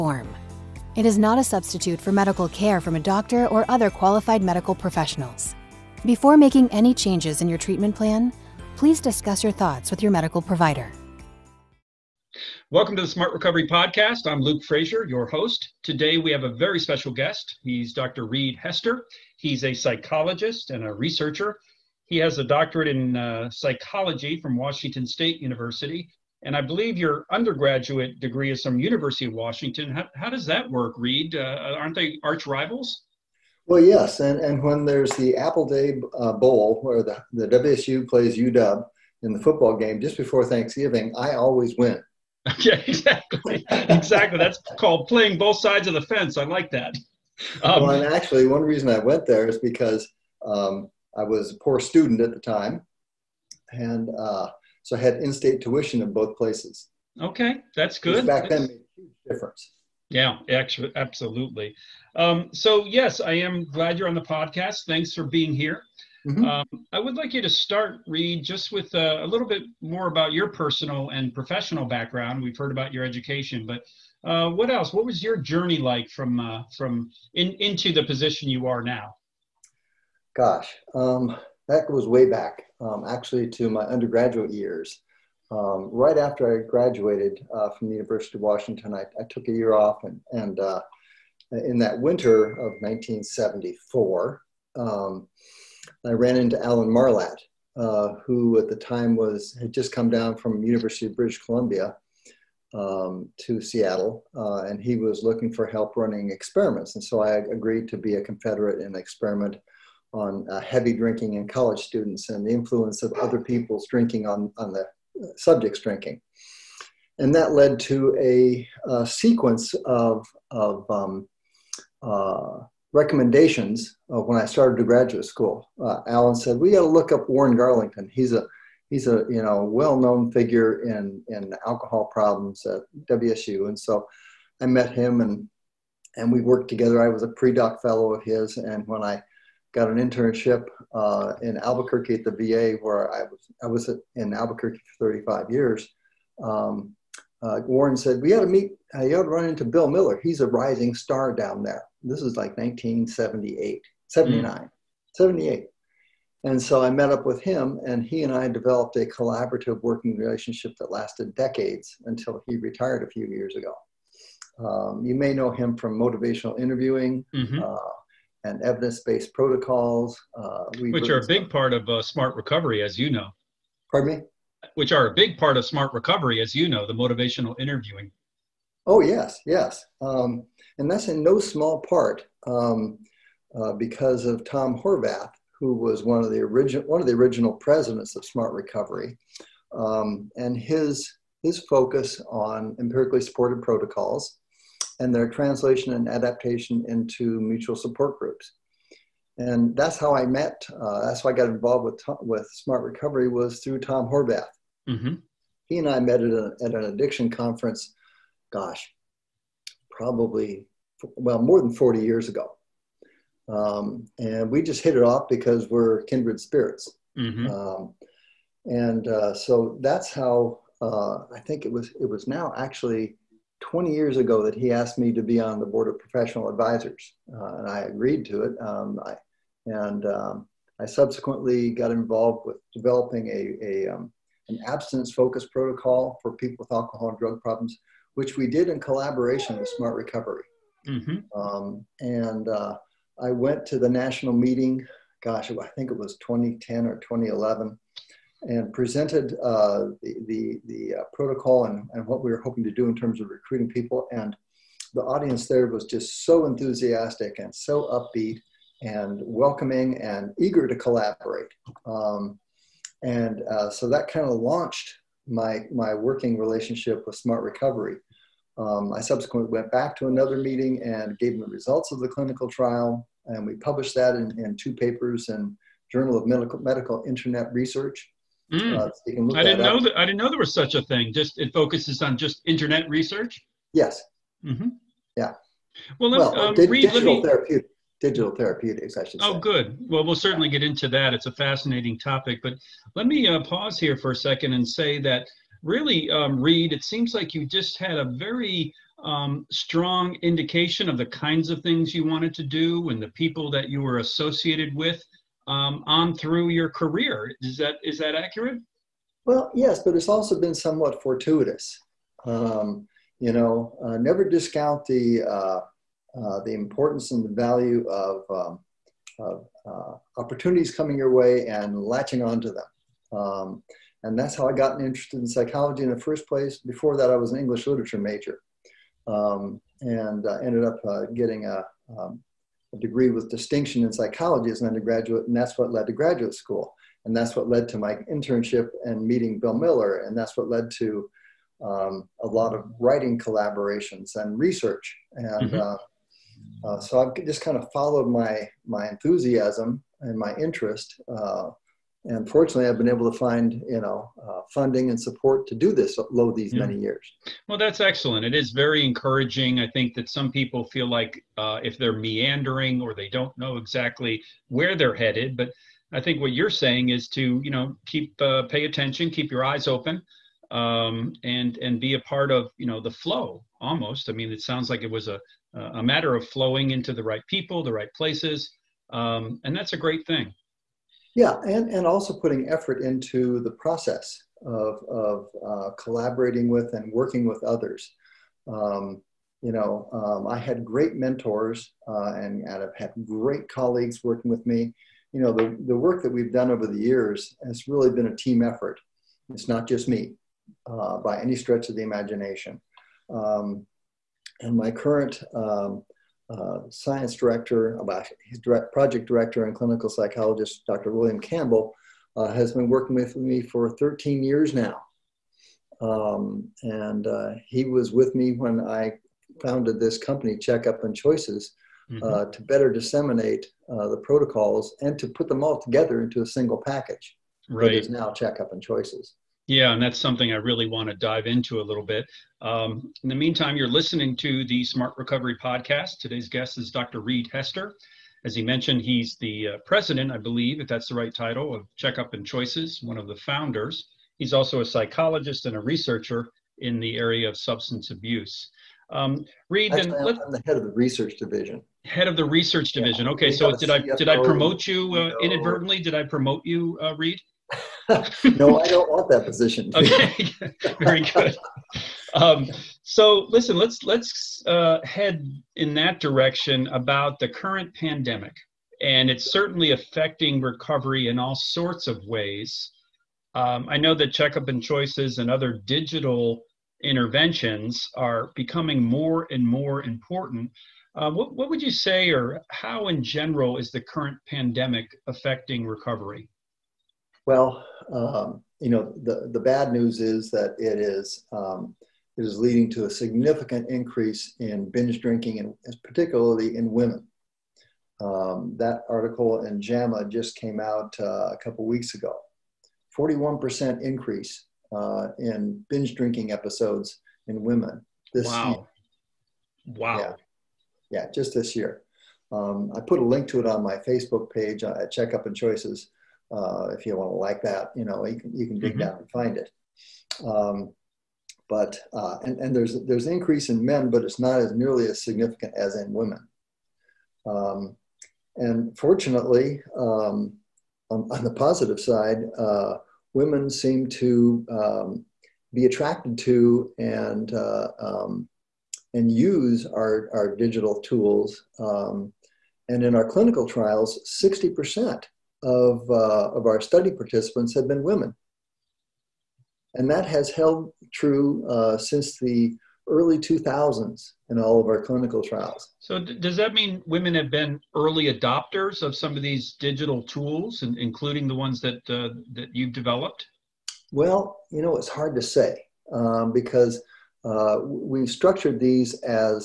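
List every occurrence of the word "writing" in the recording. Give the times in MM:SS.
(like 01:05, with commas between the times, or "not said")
05:42.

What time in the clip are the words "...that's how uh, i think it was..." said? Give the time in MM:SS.
03:39.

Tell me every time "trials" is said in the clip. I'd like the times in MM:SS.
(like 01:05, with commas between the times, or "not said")
04:32, 09:03, 09:15.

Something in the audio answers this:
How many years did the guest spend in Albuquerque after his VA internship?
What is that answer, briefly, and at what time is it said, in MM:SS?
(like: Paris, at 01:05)
35, at 02:25.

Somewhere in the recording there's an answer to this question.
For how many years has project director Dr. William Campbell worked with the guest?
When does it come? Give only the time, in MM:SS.
06:53.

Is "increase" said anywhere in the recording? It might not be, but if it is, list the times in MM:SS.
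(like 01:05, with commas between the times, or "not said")
08:13, 08:23, 08:43.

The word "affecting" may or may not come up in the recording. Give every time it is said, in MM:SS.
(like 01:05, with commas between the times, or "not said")
07:49, 08:05.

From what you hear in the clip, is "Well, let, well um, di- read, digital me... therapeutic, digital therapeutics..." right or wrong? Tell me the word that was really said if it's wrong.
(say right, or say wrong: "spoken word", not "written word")
right.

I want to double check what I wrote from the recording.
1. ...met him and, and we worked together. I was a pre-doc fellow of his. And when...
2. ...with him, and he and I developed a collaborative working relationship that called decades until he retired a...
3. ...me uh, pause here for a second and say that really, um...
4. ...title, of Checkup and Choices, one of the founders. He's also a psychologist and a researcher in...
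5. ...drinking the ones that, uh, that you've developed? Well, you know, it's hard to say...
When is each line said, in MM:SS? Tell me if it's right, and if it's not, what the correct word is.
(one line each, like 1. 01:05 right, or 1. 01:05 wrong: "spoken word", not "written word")
1. 02:14 right
2. 02:37 wrong: "lasted", not "called"
3. 04:53 right
4. 07:21 right
5. 09:20 wrong: "including", not "drinking".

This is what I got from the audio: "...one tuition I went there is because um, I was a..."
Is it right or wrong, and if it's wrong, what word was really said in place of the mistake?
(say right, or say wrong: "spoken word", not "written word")
wrong: "reason", not "tuition".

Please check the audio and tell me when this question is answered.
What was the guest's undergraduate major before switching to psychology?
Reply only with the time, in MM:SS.
05:27.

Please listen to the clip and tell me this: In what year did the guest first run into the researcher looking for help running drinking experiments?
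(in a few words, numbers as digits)
1974.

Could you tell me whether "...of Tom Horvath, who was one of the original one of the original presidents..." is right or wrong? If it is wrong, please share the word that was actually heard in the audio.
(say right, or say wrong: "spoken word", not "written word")
right.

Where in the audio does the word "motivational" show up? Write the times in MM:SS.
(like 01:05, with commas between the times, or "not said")
02:45, 02:56.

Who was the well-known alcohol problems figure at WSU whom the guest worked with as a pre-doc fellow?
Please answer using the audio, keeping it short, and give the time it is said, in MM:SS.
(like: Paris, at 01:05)
Warren Garlington, at 02:07.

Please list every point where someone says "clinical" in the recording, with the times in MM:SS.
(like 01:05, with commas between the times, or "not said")
04:32, 06:49, 09:03, 09:14.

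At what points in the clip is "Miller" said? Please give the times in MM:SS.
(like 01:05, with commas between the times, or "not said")
02:29, 05:39.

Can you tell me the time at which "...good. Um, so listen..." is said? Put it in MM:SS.
07:41.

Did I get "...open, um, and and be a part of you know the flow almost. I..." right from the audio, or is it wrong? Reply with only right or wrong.
right.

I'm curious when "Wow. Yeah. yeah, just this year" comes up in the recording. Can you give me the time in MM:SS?
08:29.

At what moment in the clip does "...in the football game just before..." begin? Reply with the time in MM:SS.
00:39.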